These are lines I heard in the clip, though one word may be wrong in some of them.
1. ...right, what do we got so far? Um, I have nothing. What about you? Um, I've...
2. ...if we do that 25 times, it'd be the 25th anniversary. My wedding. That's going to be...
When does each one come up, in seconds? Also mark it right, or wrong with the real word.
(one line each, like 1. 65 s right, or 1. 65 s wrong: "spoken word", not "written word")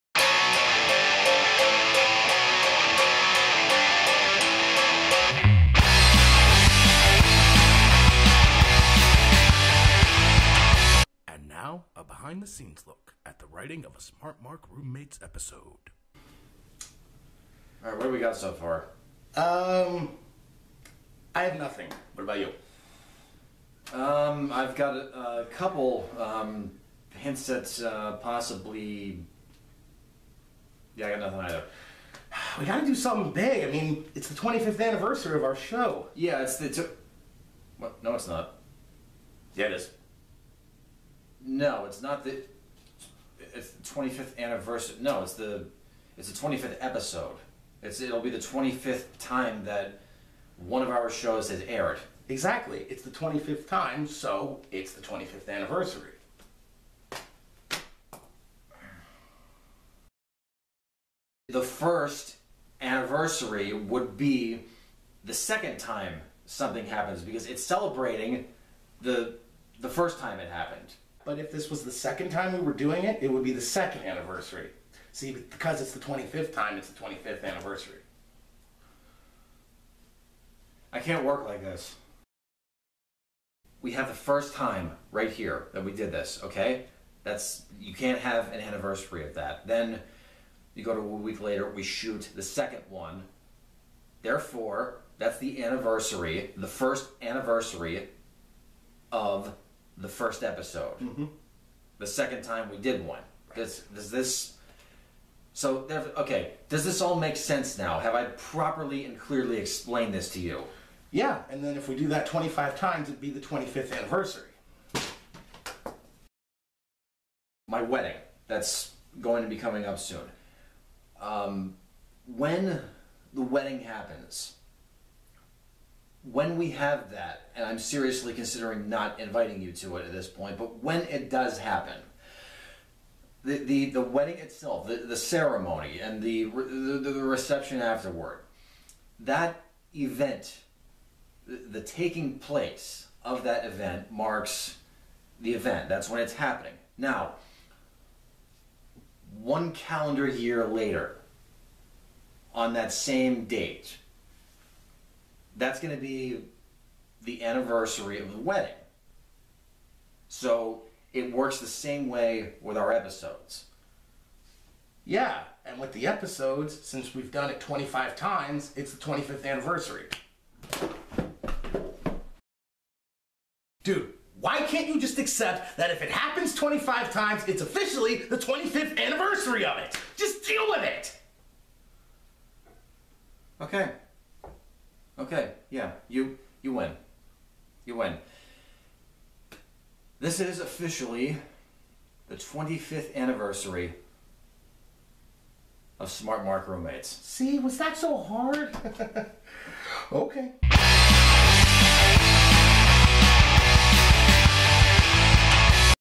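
1. 17 s right
2. 111 s right.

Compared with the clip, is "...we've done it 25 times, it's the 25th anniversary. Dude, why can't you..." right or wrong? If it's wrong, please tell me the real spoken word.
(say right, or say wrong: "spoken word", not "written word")
right.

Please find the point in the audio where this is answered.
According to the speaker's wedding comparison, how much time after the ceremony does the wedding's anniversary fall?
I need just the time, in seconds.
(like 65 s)
149 s.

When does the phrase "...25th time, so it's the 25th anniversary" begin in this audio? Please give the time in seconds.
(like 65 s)
53 s.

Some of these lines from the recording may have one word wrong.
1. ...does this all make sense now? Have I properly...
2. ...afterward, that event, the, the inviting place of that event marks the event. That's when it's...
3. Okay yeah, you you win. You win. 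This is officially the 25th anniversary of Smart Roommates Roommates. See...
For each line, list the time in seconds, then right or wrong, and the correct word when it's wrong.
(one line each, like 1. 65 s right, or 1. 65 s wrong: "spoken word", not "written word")
1. 106 s right
2. 137 s wrong: "taking", not "inviting"
3. 183 s wrong: "Mark", not "Roommates".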